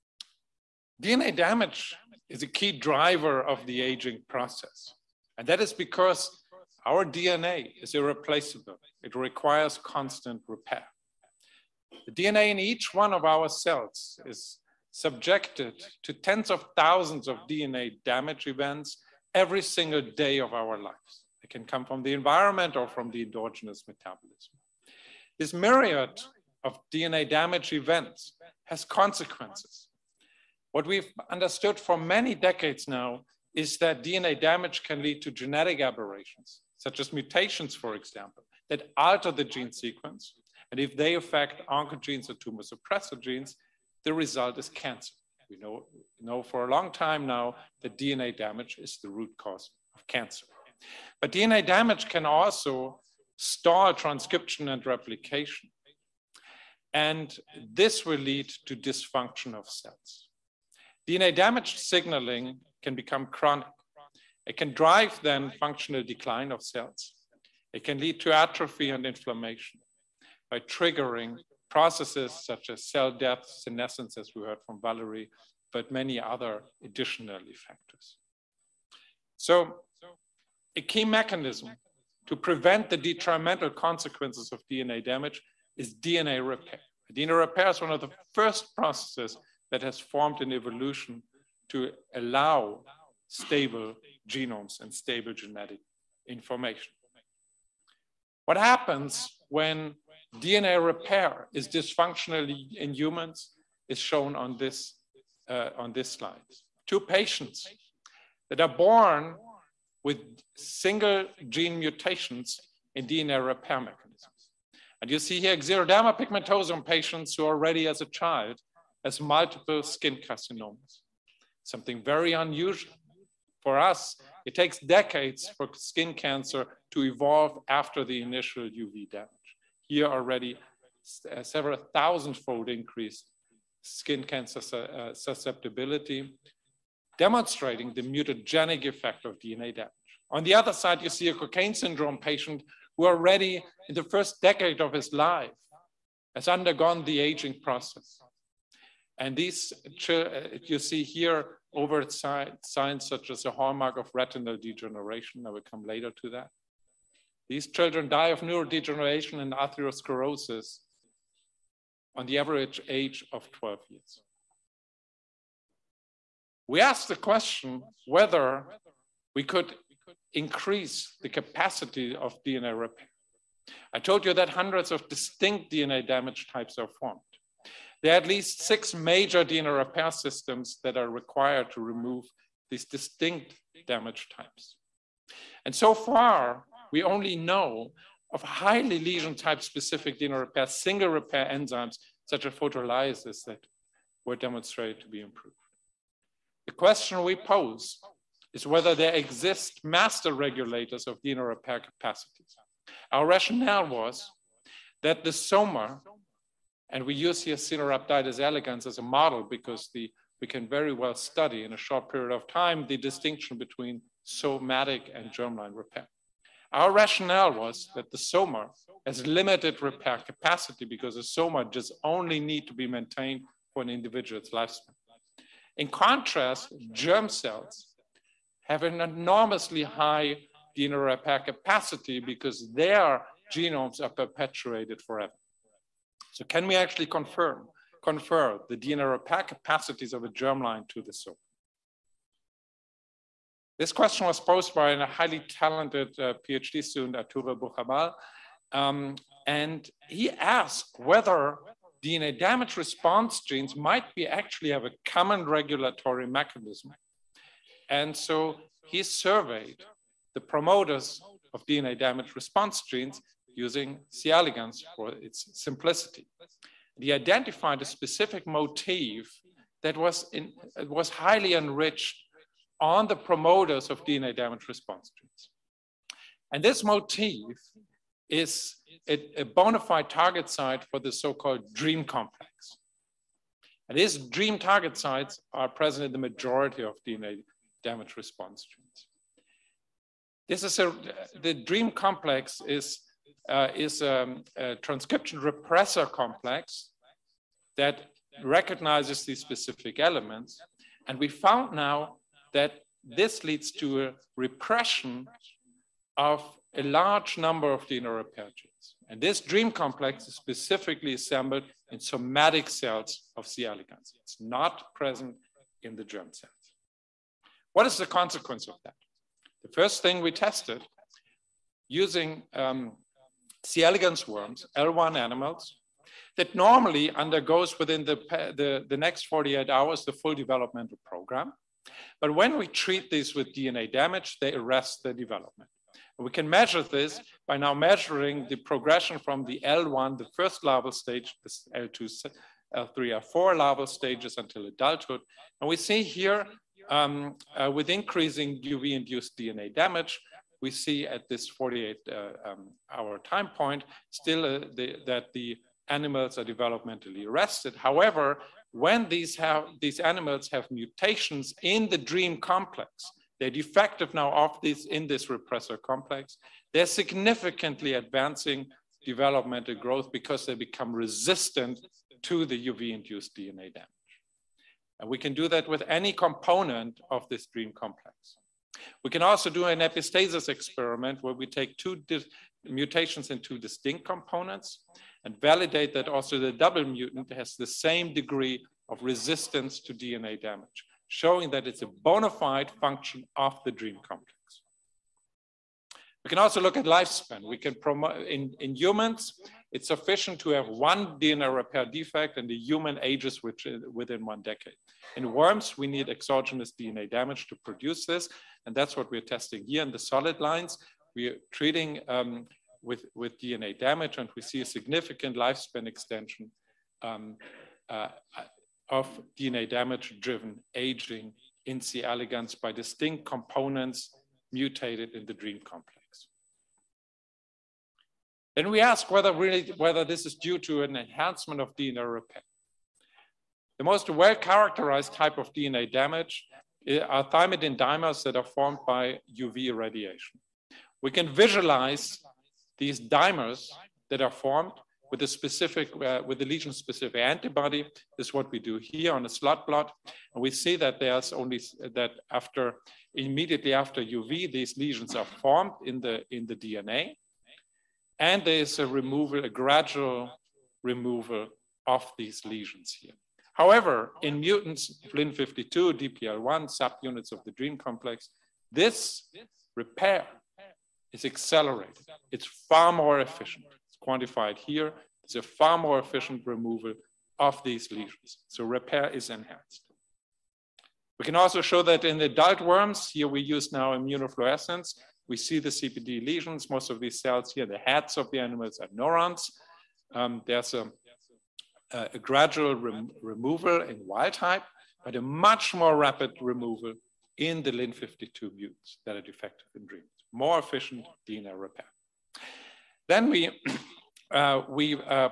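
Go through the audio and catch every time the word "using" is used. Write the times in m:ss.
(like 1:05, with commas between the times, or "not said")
4:23, 5:21.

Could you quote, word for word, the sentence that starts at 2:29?
And these, you see here, overt signs such as a hallmark of retinal degeneration.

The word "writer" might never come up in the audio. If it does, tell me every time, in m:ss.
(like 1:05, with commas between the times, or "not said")
not said.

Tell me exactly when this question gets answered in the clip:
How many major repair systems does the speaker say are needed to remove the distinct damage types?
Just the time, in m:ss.
2:58.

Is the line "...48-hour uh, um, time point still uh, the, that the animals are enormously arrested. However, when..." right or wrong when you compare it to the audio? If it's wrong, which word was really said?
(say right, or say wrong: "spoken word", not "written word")
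wrong: "developmentally", not "enormously".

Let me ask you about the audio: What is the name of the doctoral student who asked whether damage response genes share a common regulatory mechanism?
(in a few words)
Arturo Bujarrabal.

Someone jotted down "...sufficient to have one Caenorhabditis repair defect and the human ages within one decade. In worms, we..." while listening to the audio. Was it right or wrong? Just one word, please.
wrong.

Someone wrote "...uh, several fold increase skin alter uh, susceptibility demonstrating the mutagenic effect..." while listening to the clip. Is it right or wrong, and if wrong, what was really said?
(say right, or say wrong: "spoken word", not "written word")
wrong: "cancer", not "alter".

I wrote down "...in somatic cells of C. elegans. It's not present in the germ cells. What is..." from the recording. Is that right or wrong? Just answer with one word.
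right.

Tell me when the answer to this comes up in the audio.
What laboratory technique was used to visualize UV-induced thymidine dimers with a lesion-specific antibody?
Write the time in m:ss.
7:29.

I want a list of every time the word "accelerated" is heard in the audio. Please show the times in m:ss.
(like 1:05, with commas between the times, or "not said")
7:51.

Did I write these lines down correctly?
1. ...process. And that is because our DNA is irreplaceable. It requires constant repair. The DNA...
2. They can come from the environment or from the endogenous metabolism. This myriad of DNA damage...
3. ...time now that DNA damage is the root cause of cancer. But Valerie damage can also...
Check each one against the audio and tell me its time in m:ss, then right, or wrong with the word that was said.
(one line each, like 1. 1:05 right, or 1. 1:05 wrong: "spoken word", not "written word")
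1. 0:04 right
2. 0:21 right
3. 0:46 wrong: "DNA", not "Valerie".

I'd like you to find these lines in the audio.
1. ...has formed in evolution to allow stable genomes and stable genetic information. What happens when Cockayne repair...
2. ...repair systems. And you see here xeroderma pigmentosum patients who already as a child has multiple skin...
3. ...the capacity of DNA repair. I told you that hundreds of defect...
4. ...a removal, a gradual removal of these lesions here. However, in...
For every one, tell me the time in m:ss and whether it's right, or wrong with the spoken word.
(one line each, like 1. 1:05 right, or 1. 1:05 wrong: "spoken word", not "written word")
1. 1:29 wrong: "DNA", not "Cockayne"
2. 1:53 wrong: "mechanisms", not "systems"
3. 2:51 wrong: "distinct", not "defect"
4. 7:38 right.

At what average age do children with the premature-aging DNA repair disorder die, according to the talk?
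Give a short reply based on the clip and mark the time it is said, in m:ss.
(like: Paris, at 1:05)
12 years, at 2:43.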